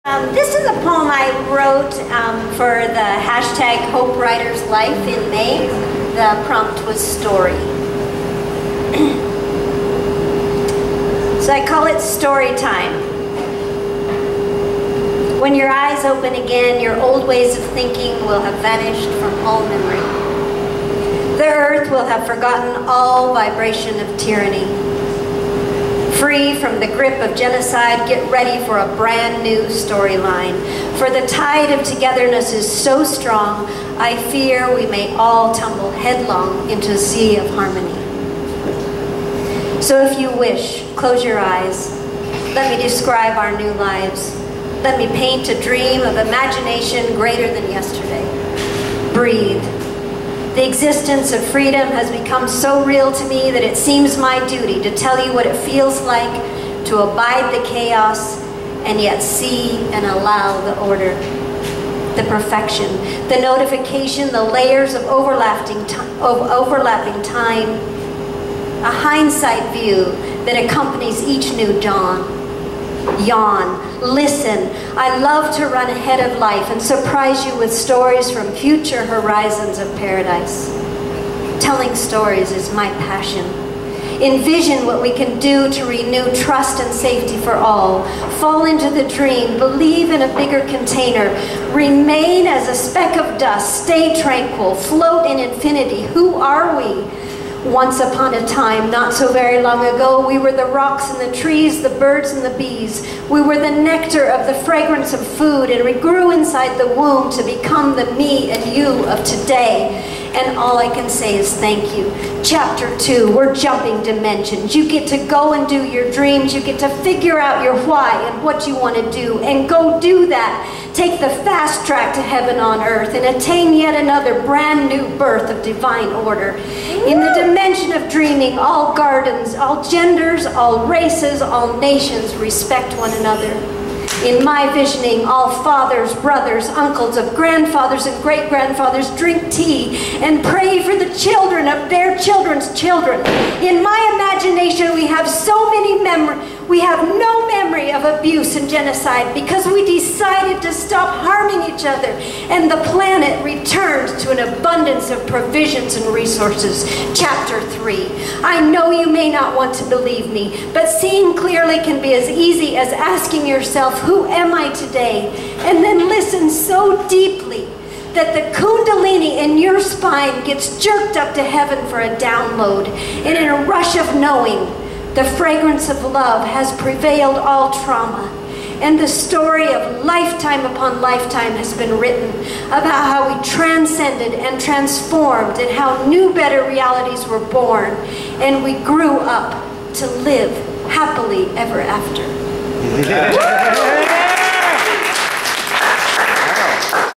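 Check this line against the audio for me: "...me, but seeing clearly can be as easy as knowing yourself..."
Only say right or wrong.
wrong.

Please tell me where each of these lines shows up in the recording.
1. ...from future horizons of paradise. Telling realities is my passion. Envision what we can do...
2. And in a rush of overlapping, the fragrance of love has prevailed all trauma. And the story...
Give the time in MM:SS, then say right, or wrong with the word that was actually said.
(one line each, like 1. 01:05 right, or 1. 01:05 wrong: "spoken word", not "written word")
1. 01:18 wrong: "stories", not "realities"
2. 02:53 wrong: "knowing", not "overlapping".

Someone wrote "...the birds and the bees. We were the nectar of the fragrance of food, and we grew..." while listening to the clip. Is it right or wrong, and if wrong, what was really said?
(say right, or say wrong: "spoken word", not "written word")
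right.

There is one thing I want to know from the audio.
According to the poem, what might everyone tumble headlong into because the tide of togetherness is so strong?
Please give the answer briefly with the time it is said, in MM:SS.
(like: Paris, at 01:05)
A sea of harmony, at 00:36.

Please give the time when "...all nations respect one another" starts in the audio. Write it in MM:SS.
02:11.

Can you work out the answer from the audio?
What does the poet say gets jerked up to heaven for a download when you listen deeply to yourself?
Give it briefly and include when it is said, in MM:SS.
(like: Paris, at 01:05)
The kundalini, at 02:48.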